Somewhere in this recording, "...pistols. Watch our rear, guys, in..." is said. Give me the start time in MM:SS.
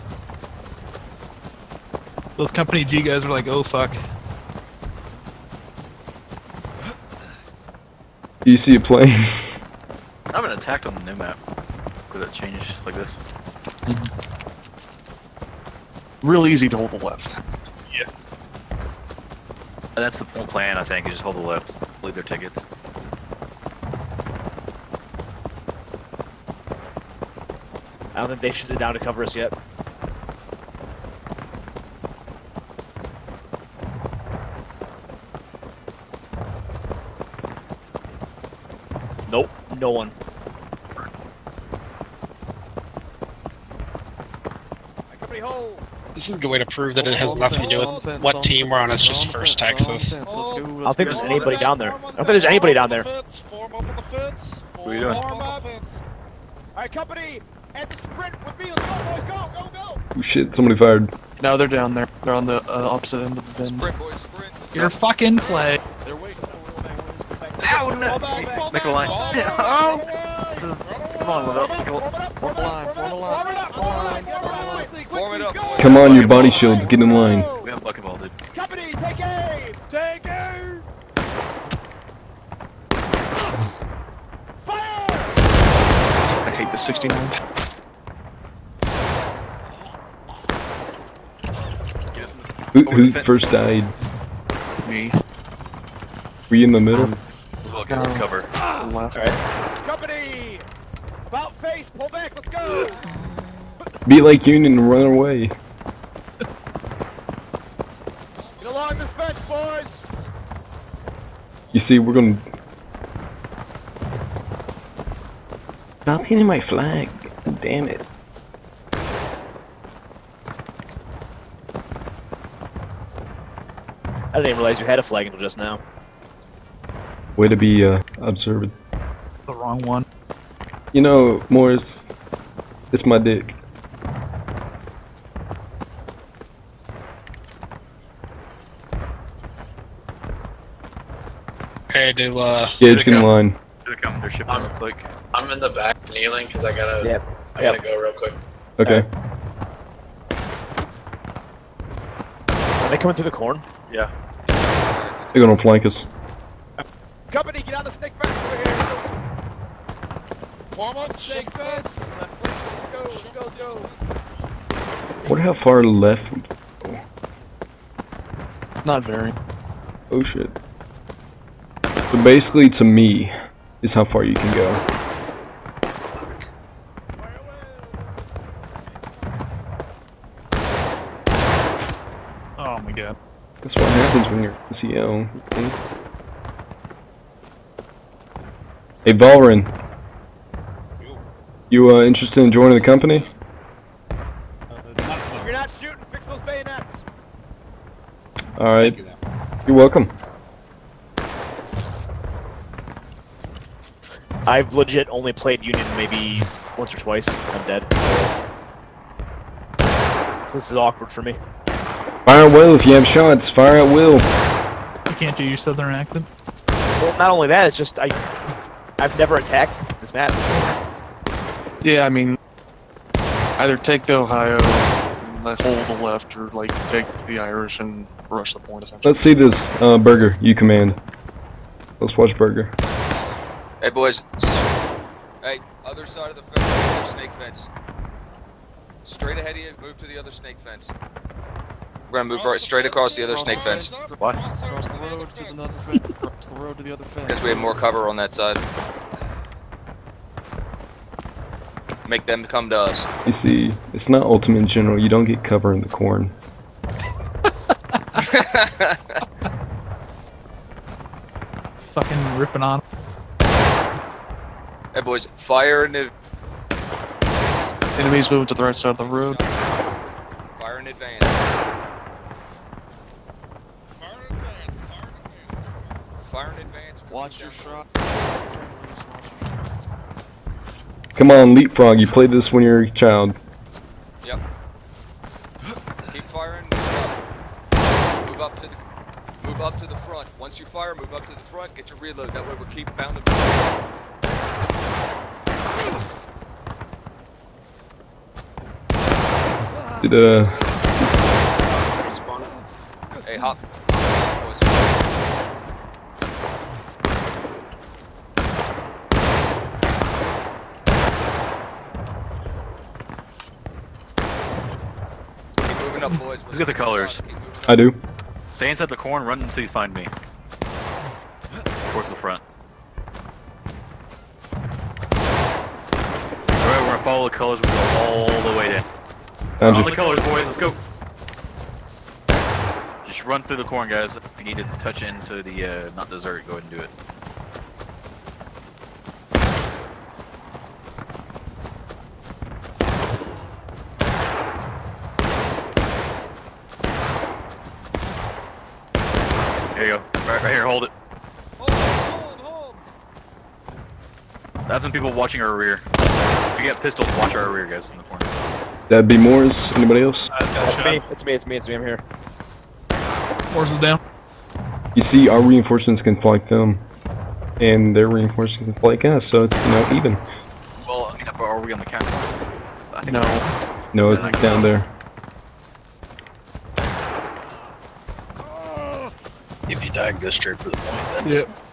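05:56.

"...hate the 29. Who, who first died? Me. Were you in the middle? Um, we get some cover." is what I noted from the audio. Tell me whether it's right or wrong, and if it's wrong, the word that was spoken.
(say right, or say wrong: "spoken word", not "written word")
wrong: "69", not "29".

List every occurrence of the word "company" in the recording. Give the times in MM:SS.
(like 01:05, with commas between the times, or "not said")
00:02, 00:56, 01:18, 01:39, 02:37, 03:12.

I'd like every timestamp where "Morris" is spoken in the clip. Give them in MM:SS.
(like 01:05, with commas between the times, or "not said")
02:11, 05:59, 06:03.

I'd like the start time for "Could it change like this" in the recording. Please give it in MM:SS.
00:12.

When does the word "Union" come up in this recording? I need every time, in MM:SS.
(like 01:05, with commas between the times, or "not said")
01:44, 03:25.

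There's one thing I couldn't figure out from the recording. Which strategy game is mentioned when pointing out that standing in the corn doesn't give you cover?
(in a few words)
Ultimate General.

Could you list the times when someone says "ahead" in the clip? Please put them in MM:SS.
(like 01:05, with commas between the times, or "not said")
03:59, 05:36.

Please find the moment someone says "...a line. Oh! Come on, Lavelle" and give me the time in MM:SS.
01:08.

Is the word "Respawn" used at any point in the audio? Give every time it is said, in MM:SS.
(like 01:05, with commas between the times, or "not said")
05:02.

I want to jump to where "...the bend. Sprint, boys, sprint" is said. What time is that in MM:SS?
01:03.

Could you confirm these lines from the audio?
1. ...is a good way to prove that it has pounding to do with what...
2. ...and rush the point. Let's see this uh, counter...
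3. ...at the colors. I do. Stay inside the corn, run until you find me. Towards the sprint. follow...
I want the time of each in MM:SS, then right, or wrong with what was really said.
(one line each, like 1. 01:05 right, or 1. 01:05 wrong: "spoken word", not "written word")
1. 00:46 wrong: "nothing", not "pounding"
2. 03:47 wrong: "burger", not "counter"
3. 05:16 wrong: "front", not "sprint".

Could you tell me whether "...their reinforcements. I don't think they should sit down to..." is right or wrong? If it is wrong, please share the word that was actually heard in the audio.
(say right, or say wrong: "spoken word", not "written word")
wrong: "tickets", not "reinforcements".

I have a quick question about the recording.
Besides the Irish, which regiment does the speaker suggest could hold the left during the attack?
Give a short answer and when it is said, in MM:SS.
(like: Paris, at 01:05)
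Ohio, at 03:44.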